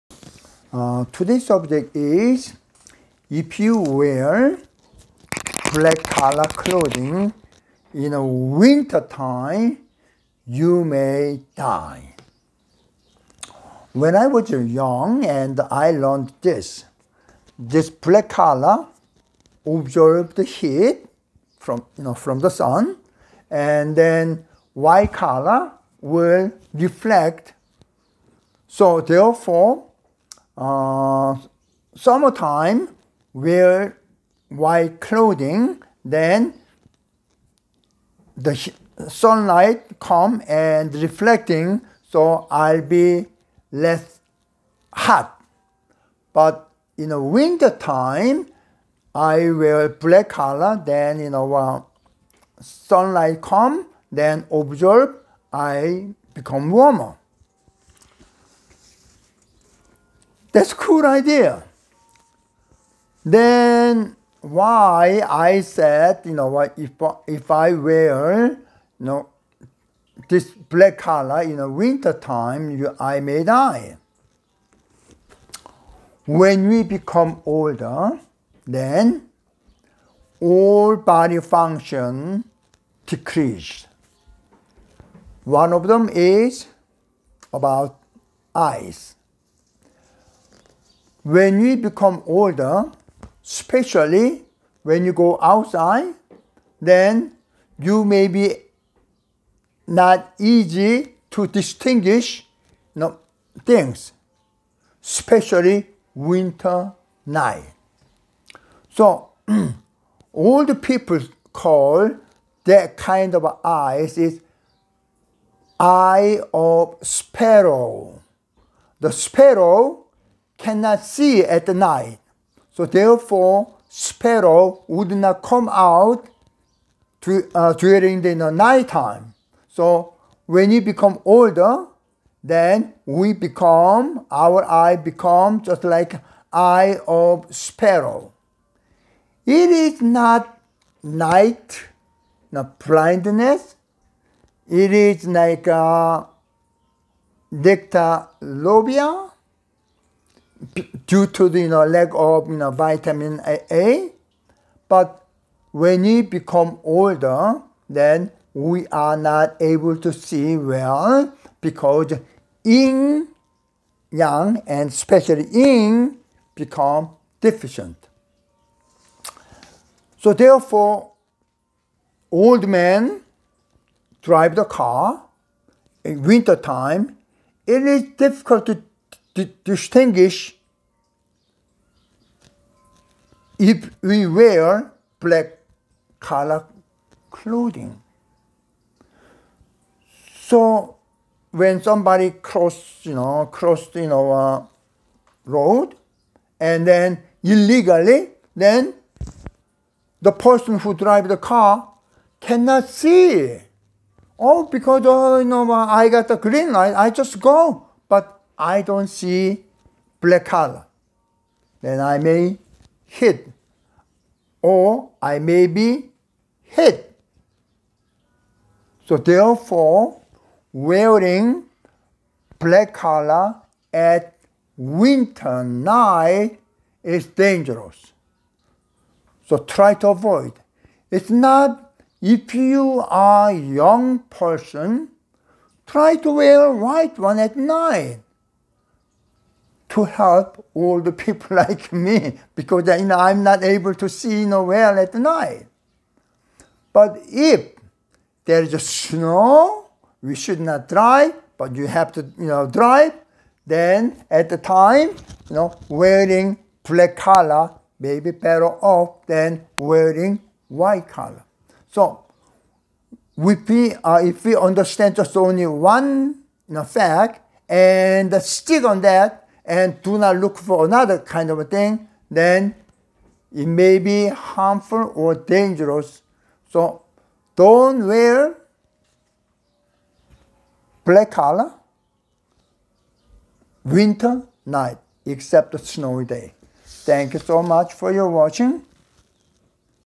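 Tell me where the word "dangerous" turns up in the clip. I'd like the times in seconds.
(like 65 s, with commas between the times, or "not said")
227 s, 275 s.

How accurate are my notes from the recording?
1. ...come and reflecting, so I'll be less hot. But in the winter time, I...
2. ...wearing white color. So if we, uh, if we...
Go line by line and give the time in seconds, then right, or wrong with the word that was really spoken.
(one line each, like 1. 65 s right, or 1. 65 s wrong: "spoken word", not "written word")
1. 39 s right
2. 259 s right.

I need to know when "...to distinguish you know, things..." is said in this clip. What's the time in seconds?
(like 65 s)
101 s.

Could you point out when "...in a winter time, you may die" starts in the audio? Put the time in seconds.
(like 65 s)
7 s.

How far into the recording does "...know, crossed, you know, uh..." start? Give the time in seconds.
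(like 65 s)
193 s.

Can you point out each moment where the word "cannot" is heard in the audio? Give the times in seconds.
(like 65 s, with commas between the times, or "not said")
120 s, 202 s.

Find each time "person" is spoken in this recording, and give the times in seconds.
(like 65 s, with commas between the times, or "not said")
200 s, 234 s.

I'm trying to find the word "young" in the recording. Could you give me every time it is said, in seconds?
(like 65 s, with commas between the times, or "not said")
14 s, 233 s.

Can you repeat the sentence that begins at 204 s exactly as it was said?
Oh, because oh, you know, uh, I got the green light, I just go.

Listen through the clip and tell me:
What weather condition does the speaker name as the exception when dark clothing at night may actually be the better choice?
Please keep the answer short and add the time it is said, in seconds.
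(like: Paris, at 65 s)
snow, at 248 s.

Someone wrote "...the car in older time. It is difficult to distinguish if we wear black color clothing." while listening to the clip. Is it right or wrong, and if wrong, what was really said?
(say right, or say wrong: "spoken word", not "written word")
wrong: "winter", not "older".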